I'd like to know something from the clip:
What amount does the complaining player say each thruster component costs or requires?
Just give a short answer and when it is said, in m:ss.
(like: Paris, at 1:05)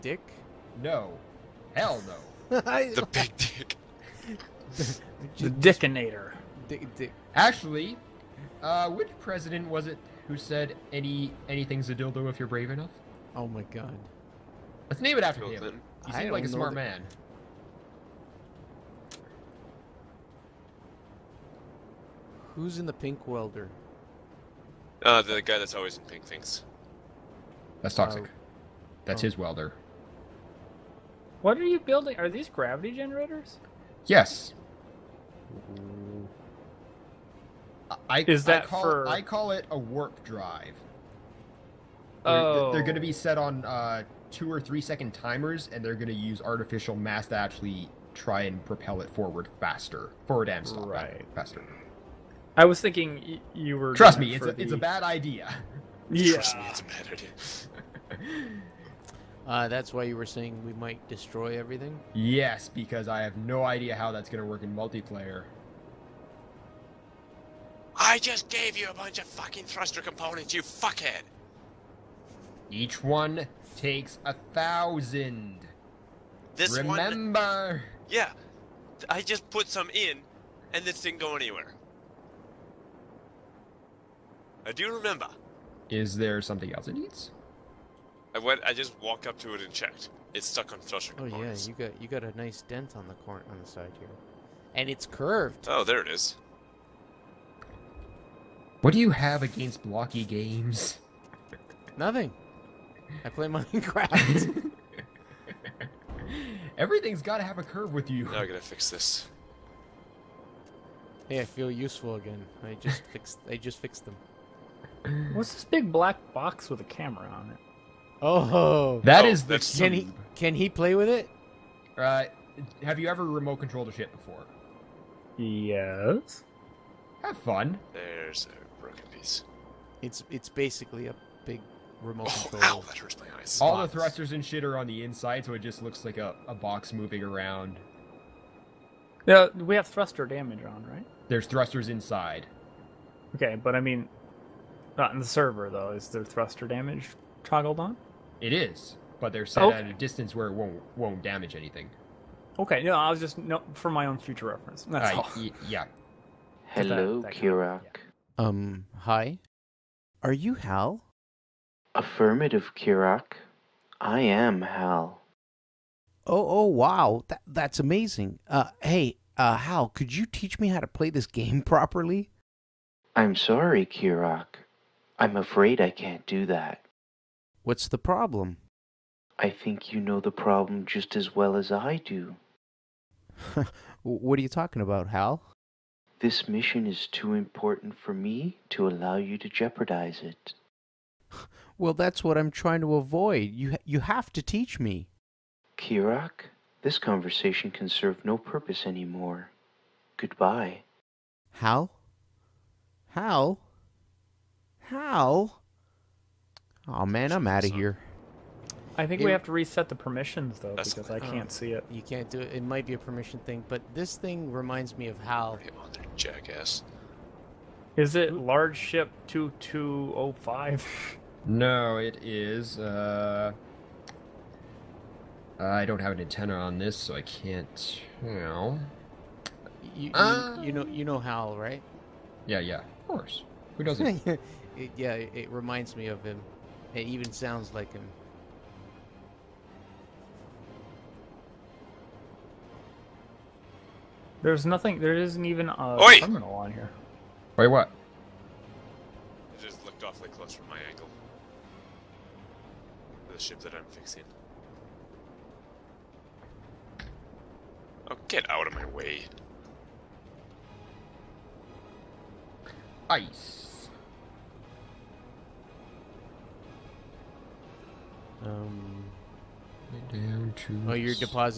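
1000, at 1:14.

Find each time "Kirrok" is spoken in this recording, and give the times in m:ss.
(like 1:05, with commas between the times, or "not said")
2:37, 2:42, 2:53, 3:15.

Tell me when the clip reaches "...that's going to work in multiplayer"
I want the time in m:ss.
1:04.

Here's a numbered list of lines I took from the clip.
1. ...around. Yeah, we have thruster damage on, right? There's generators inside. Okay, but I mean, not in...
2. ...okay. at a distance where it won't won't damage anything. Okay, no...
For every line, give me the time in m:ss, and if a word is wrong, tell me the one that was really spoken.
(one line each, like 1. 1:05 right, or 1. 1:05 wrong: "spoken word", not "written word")
1. 2:17 wrong: "thrusters", not "generators"
2. 2:29 right.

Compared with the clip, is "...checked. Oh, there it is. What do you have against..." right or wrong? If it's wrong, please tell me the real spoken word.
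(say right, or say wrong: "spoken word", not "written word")
wrong: "curved", not "checked".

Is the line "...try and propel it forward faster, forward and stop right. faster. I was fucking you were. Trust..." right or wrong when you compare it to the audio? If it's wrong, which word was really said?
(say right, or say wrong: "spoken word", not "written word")
wrong: "thinking", not "fucking".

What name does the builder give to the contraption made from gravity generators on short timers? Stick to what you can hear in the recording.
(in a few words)
warp drive.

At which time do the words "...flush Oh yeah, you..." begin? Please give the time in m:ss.
1:30.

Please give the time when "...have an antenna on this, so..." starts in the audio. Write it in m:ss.
3:45.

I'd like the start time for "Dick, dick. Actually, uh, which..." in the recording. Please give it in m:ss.
0:06.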